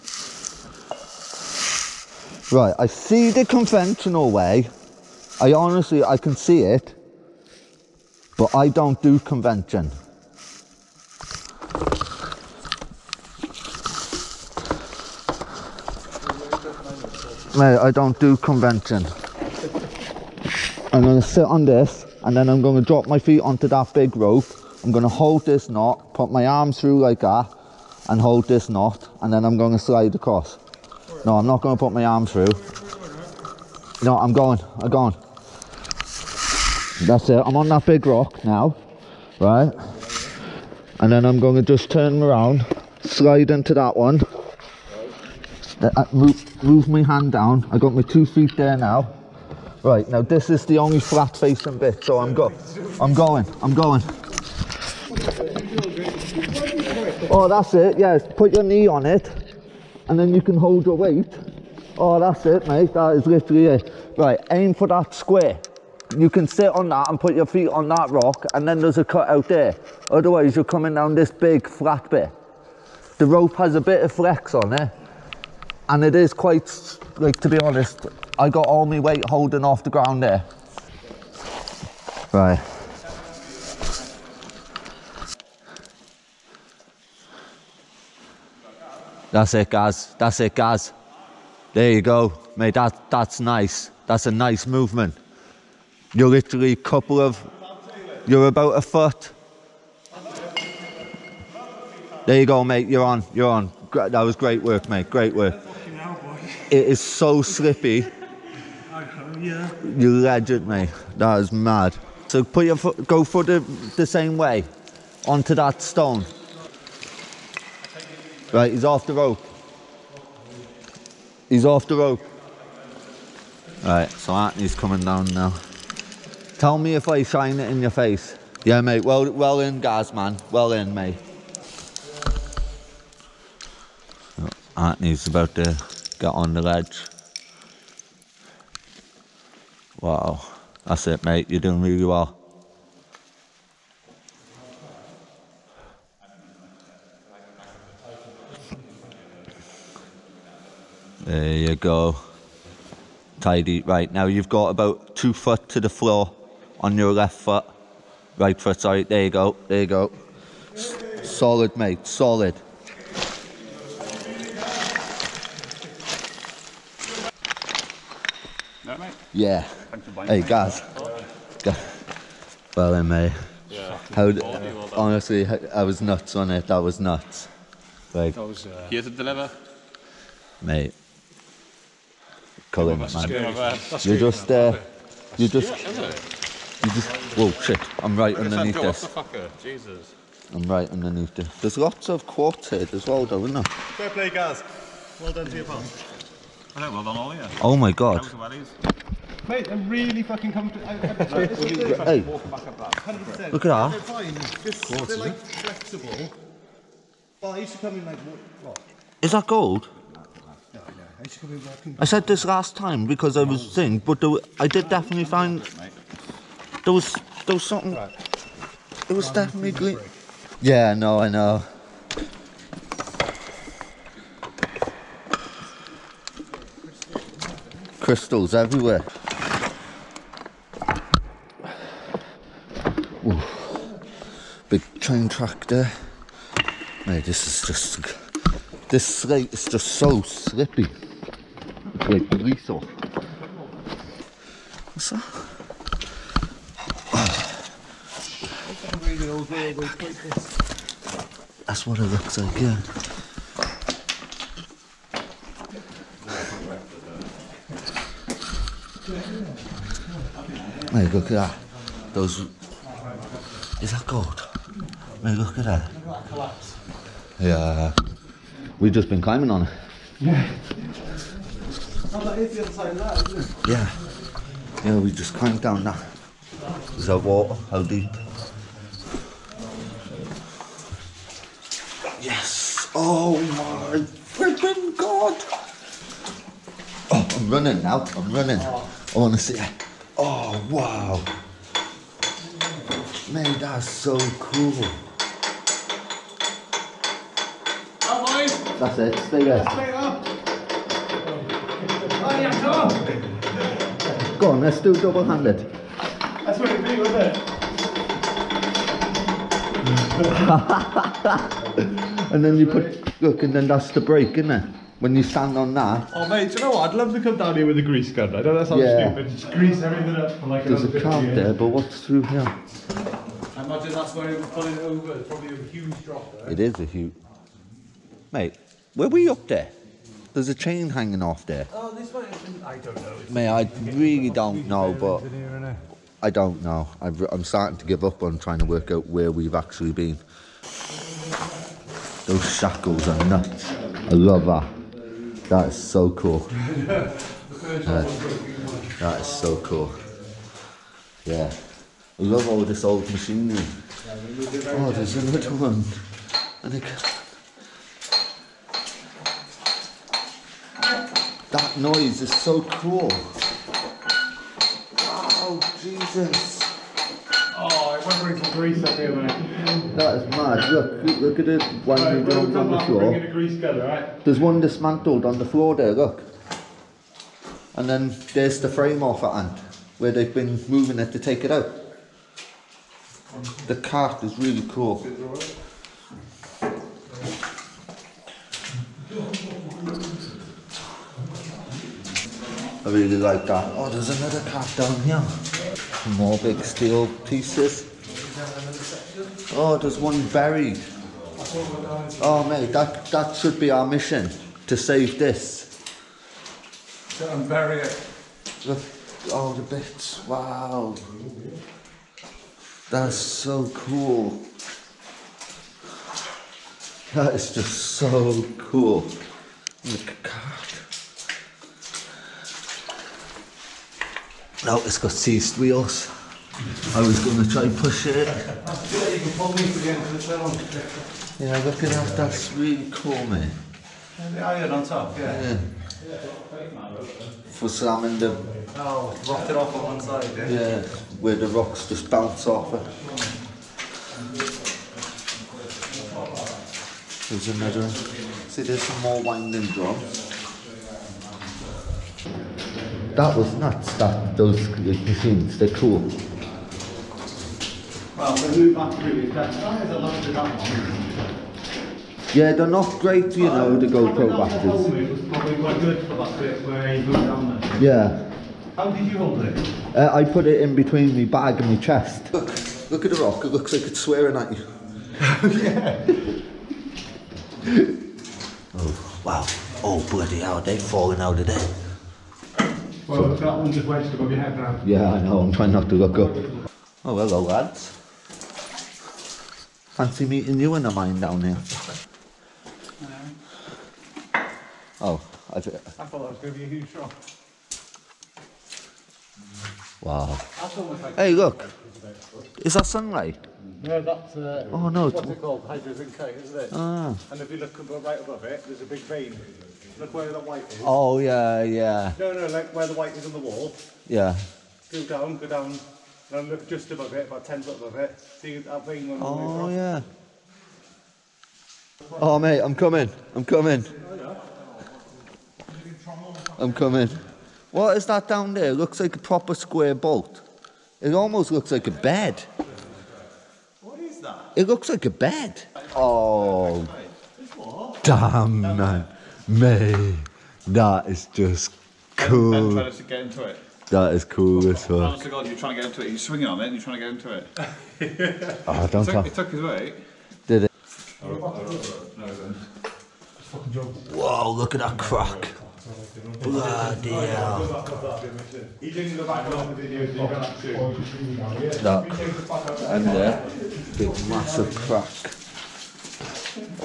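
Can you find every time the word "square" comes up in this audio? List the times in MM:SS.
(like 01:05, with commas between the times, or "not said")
01:05, 08:49.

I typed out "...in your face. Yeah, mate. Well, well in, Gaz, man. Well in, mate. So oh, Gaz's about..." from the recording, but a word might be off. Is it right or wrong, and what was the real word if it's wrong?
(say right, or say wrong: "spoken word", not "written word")
wrong: "Anthony", not "Gaz".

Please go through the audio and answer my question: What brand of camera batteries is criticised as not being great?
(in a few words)
GoPro.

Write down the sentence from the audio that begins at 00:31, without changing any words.
No, I'm not going to put my arm through.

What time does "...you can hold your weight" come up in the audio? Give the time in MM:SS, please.
01:00.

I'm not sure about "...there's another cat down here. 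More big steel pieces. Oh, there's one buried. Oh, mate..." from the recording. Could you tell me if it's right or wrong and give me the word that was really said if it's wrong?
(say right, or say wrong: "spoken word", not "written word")
right.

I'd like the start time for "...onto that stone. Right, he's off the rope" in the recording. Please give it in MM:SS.
01:55.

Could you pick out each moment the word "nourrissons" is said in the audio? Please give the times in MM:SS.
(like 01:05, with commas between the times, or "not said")
04:02.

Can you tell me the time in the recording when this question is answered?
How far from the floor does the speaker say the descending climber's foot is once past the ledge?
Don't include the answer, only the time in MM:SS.
02:35.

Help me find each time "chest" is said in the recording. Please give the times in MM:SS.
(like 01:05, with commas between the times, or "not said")
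07:51.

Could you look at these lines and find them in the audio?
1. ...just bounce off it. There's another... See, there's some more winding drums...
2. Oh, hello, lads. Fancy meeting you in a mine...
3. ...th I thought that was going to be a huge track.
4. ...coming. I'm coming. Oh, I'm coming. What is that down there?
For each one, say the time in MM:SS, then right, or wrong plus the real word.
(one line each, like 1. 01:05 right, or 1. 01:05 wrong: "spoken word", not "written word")
1. 07:21 right
2. 08:07 right
3. 08:15 wrong: "shock", not "track"
4. 08:42 right.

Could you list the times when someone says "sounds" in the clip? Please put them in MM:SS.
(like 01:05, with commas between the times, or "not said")
05:18.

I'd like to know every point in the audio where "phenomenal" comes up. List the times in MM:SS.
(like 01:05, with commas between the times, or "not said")
not said.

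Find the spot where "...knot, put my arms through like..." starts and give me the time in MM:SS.
00:25.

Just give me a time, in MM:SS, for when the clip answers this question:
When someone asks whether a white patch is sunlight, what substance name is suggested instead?
08:25.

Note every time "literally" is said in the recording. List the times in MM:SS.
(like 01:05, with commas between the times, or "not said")
01:03, 01:36.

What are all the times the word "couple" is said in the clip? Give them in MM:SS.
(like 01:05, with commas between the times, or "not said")
01:36.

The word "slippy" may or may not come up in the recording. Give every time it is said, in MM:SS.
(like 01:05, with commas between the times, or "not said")
01:47, 04:00.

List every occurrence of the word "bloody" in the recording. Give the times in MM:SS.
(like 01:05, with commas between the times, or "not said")
08:00, 09:16.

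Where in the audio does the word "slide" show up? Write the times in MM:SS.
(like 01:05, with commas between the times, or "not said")
00:29, 00:43.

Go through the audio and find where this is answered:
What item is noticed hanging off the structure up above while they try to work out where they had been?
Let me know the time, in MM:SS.
05:30.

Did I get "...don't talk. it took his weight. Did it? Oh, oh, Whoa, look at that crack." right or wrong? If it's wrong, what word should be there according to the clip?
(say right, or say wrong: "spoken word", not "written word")
right.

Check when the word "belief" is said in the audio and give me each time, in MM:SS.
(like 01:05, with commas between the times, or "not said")
not said.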